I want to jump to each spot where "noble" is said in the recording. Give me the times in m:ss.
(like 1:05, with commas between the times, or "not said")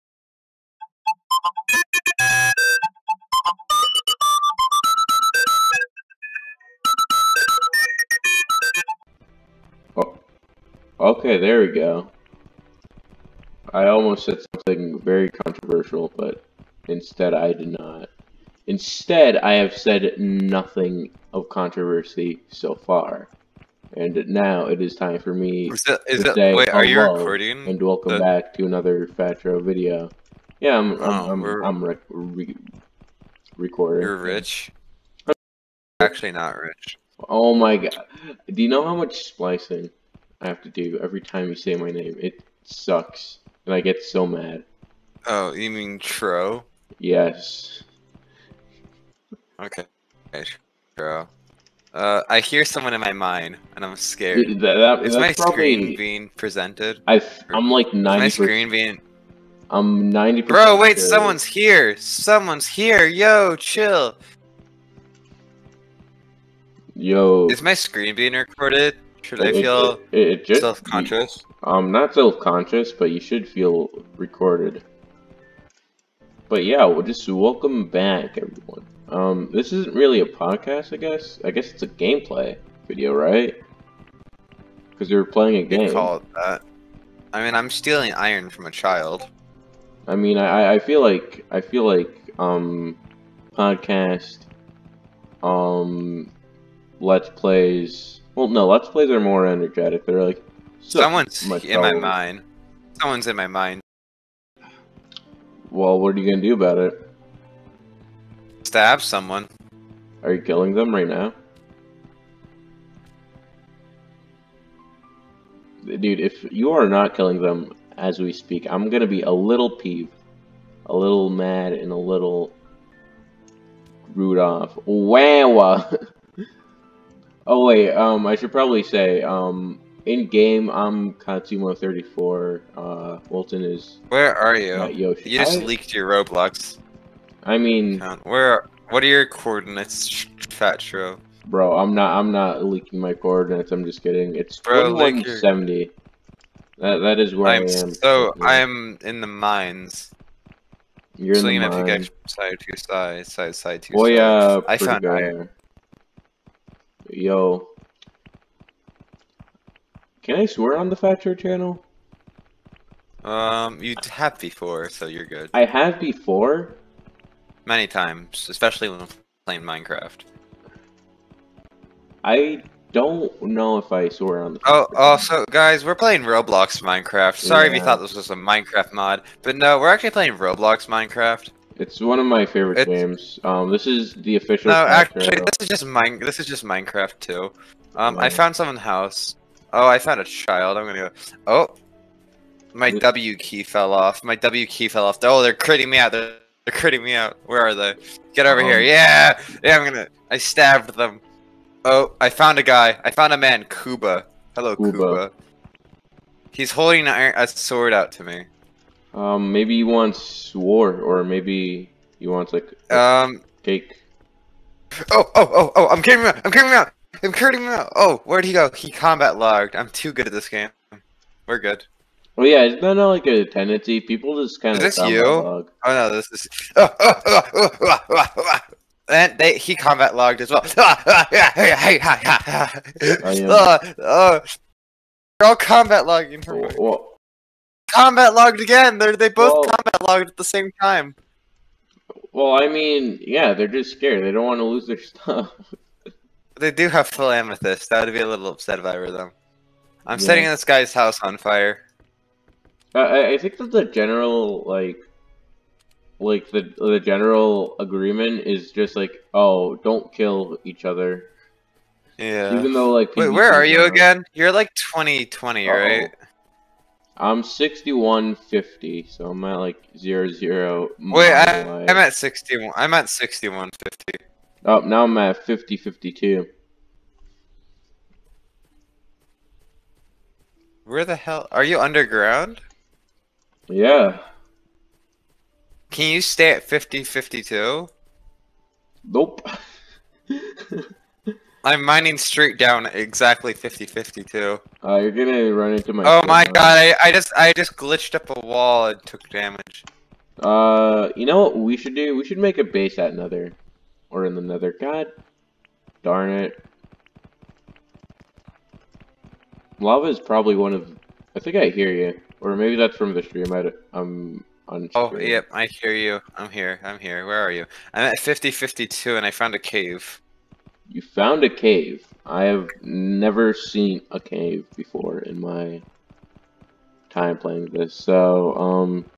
not said.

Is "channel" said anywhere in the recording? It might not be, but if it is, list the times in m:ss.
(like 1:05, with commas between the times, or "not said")
2:41.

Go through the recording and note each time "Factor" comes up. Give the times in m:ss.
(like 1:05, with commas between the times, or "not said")
2:40.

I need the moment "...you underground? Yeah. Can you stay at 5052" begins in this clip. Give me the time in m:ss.
4:41.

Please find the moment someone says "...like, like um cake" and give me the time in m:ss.
3:32.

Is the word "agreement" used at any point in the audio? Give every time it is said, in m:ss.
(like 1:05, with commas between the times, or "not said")
4:17.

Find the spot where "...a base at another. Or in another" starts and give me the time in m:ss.
5:02.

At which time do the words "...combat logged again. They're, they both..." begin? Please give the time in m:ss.
3:57.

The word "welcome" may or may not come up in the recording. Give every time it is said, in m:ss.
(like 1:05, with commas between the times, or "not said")
0:27, 1:17.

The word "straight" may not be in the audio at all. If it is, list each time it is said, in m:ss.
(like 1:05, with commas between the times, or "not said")
4:52.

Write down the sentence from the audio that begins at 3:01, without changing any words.
It's one of my favorite it's...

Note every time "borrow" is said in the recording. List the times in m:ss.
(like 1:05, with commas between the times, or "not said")
not said.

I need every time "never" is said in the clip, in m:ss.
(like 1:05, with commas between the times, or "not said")
5:22.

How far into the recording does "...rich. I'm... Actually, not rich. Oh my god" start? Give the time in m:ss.
0:34.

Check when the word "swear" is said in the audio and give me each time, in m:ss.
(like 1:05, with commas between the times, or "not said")
2:40, 2:54.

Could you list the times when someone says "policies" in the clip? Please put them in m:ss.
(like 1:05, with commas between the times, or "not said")
not said.